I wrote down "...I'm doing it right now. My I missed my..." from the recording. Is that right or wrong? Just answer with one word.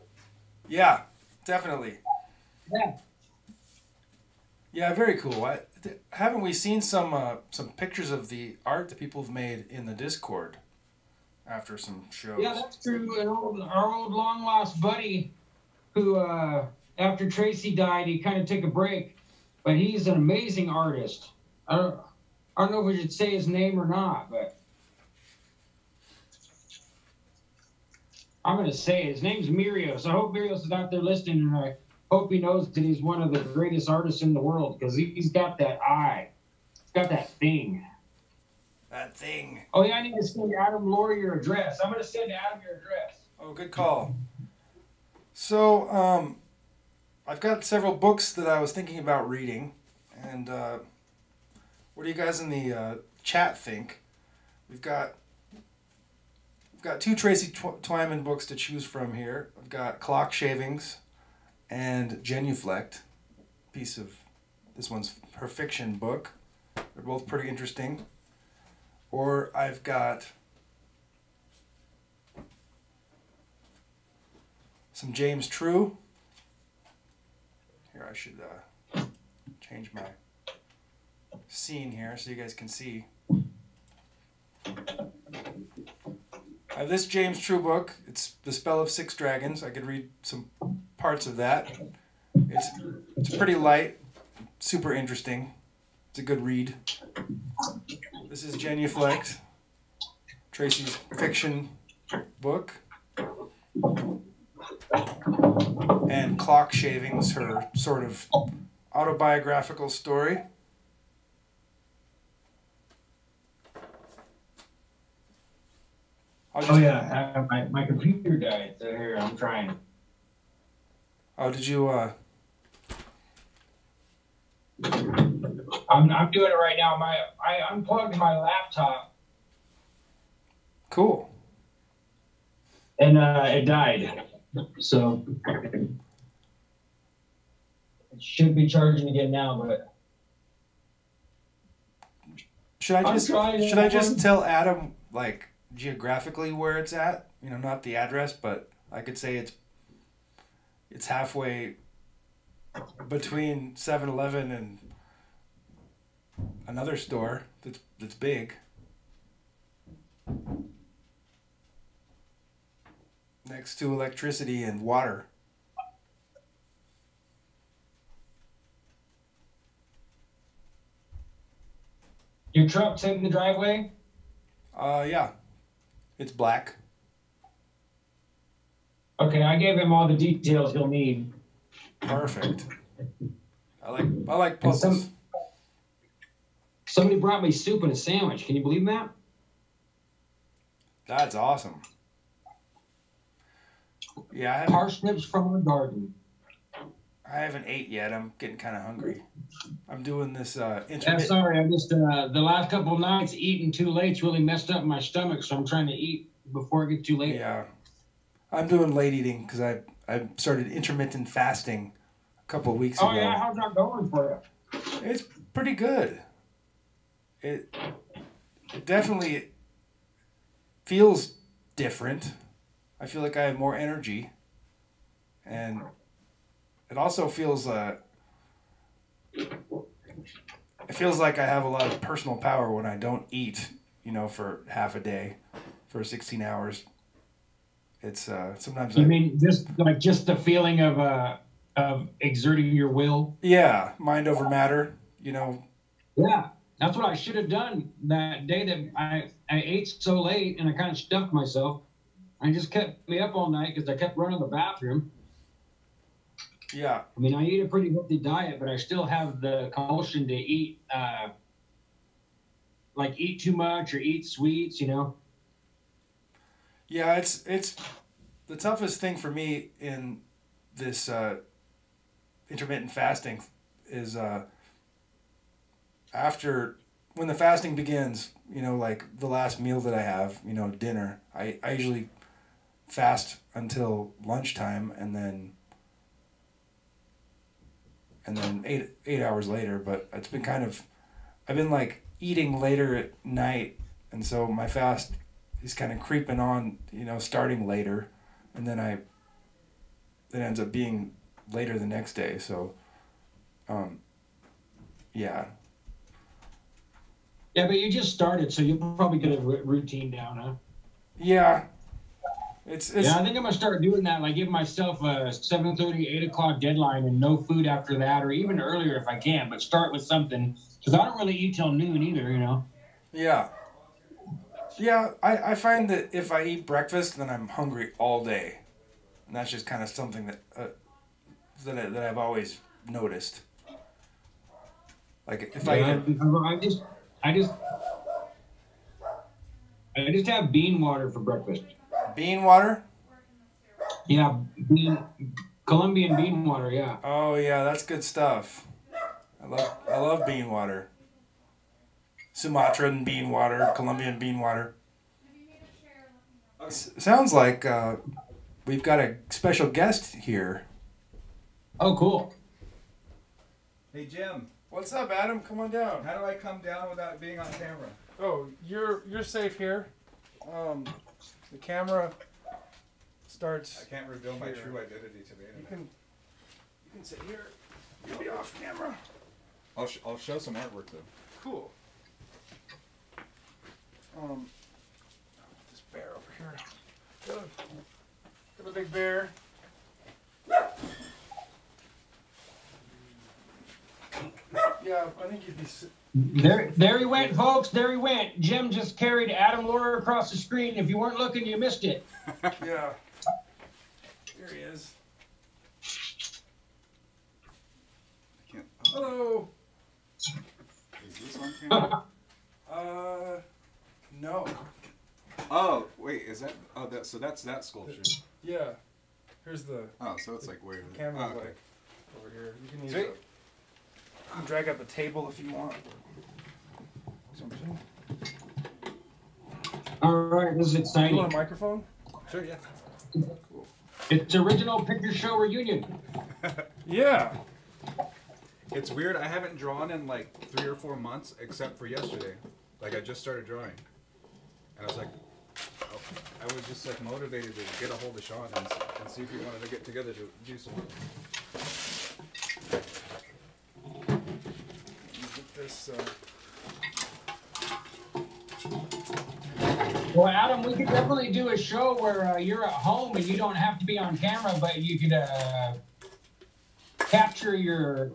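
wrong.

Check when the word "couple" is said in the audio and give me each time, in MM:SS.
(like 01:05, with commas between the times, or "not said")
03:22, 03:32.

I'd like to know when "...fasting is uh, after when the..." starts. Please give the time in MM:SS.
04:32.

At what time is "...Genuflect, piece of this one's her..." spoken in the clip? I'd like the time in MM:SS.
01:02.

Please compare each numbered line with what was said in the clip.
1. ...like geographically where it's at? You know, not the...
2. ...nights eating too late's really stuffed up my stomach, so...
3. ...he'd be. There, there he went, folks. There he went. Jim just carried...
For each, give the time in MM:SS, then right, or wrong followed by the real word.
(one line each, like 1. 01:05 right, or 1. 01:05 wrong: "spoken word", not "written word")
1. 02:25 right
2. 03:22 wrong: "messed", not "stuffed"
3. 06:35 right.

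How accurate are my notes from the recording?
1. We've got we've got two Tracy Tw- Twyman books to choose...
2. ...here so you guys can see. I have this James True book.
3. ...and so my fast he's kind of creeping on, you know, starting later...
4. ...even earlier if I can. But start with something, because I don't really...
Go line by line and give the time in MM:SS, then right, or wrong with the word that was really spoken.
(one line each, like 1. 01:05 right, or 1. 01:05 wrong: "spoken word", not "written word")
1. 00:54 right
2. 01:21 right
3. 04:54 right
4. 05:18 right.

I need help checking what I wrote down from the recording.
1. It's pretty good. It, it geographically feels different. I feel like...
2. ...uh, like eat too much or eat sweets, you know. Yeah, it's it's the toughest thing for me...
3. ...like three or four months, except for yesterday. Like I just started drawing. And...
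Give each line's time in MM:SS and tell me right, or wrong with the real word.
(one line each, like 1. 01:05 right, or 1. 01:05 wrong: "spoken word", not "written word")
1. 03:35 wrong: "definitely", not "geographically"
2. 04:20 right
3. 07:20 right.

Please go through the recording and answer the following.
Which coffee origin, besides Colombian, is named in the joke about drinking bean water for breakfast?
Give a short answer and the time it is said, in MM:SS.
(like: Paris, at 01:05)
Sumatra, at 05:52.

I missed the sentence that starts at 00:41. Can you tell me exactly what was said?
I'm gonna send Adam your address.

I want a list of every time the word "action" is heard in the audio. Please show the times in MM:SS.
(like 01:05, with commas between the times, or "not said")
not said.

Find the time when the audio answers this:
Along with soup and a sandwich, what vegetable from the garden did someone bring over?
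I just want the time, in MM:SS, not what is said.
03:14.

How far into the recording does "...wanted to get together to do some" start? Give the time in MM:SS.
07:29.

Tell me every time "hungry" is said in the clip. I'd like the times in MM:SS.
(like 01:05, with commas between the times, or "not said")
03:18, 05:27.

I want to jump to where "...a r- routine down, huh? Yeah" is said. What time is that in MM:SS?
05:09.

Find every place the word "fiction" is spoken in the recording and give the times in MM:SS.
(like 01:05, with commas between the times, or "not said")
01:05, 01:41.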